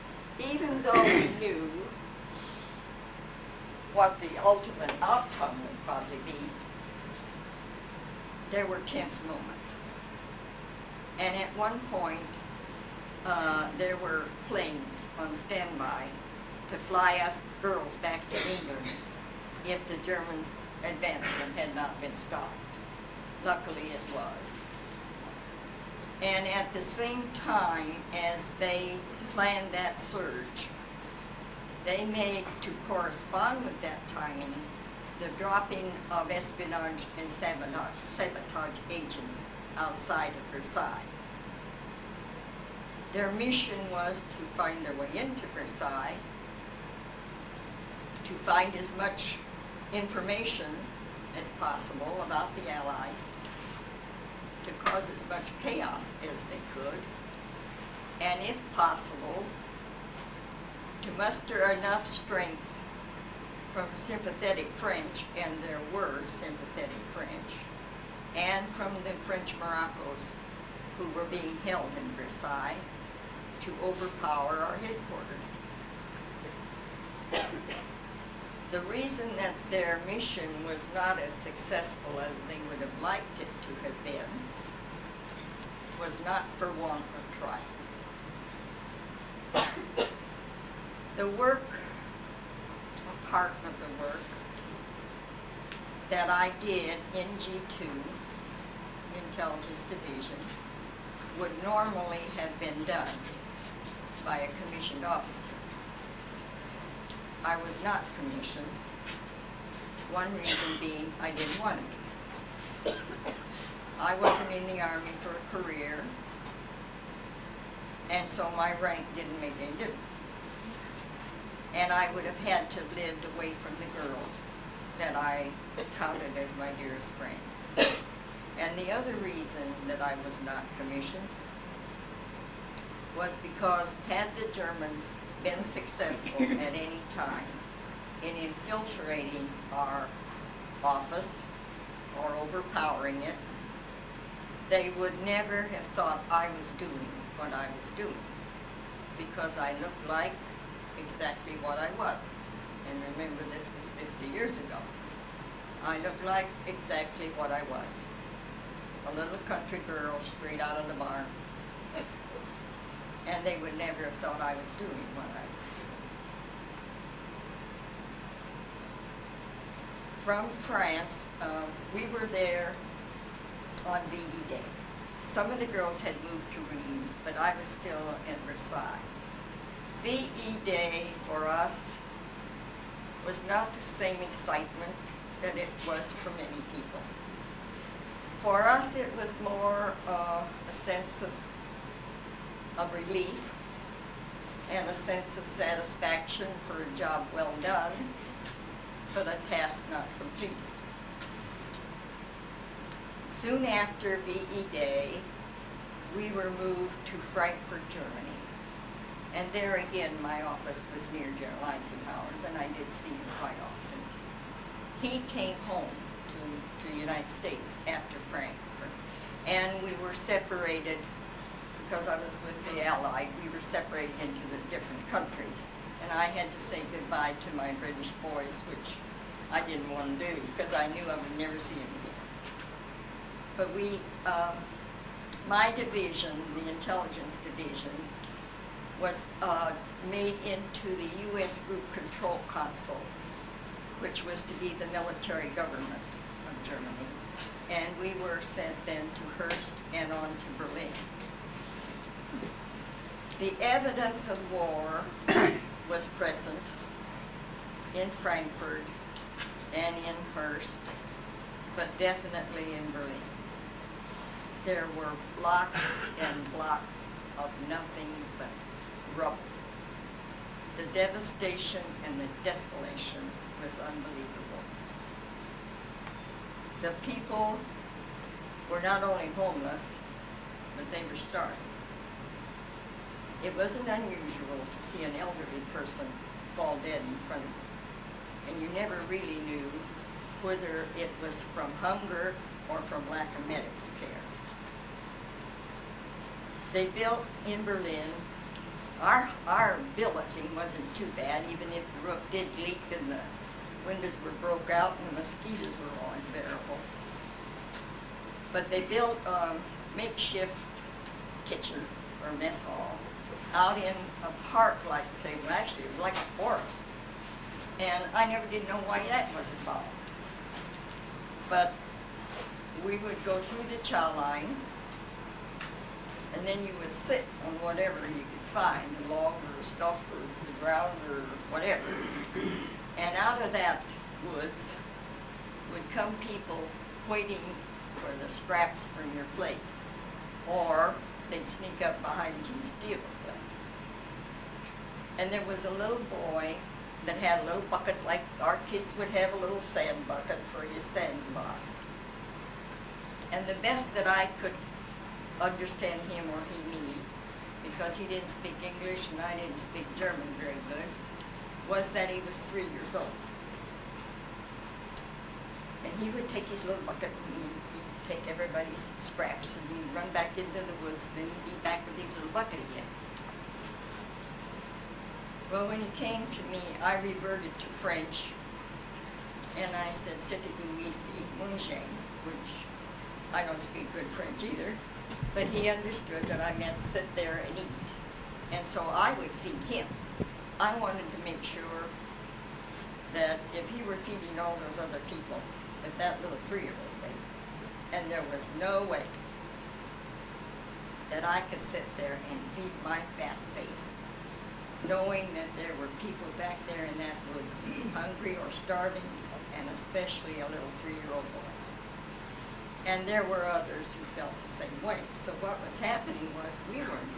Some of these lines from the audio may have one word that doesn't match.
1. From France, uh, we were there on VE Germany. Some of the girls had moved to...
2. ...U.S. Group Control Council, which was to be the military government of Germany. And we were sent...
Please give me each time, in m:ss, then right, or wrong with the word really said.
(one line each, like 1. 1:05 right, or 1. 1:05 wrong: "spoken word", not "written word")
1. 2:50 wrong: "Day", not "Germany"
2. 4:01 right.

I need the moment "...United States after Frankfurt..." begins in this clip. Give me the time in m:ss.
3:36.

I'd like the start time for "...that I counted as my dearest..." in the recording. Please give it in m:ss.
2:04.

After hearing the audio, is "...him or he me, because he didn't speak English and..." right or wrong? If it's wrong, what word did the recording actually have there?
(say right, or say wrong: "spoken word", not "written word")
right.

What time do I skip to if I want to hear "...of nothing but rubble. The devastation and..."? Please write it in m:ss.
4:27.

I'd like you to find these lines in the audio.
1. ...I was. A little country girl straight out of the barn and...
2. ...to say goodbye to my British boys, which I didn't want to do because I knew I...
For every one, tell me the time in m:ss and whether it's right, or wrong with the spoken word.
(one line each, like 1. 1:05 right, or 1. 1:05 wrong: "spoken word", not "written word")
1. 2:37 right
2. 3:46 right.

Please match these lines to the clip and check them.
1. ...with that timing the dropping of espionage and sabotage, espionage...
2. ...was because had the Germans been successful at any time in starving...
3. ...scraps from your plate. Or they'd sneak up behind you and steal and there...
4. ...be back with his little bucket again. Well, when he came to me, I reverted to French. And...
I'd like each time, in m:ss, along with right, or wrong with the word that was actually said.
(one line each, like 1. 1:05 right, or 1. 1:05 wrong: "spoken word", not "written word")
1. 0:33 wrong: "sabotage", not "espionage"
2. 2:13 wrong: "infiltrating", not "starving"
3. 5:38 right
4. 6:11 right.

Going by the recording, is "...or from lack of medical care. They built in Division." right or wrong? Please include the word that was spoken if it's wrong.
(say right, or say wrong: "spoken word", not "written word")
wrong: "Berlin", not "Division".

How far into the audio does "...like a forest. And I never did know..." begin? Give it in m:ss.
5:15.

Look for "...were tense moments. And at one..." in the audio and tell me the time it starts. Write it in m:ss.
0:08.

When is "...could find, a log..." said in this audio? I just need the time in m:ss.
5:28.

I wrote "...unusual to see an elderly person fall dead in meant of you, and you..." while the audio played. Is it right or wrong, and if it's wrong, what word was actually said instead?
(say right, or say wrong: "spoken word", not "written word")
wrong: "front", not "meant".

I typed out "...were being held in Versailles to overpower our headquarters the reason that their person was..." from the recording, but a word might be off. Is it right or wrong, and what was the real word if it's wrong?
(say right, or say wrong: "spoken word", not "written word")
wrong: "mission", not "person".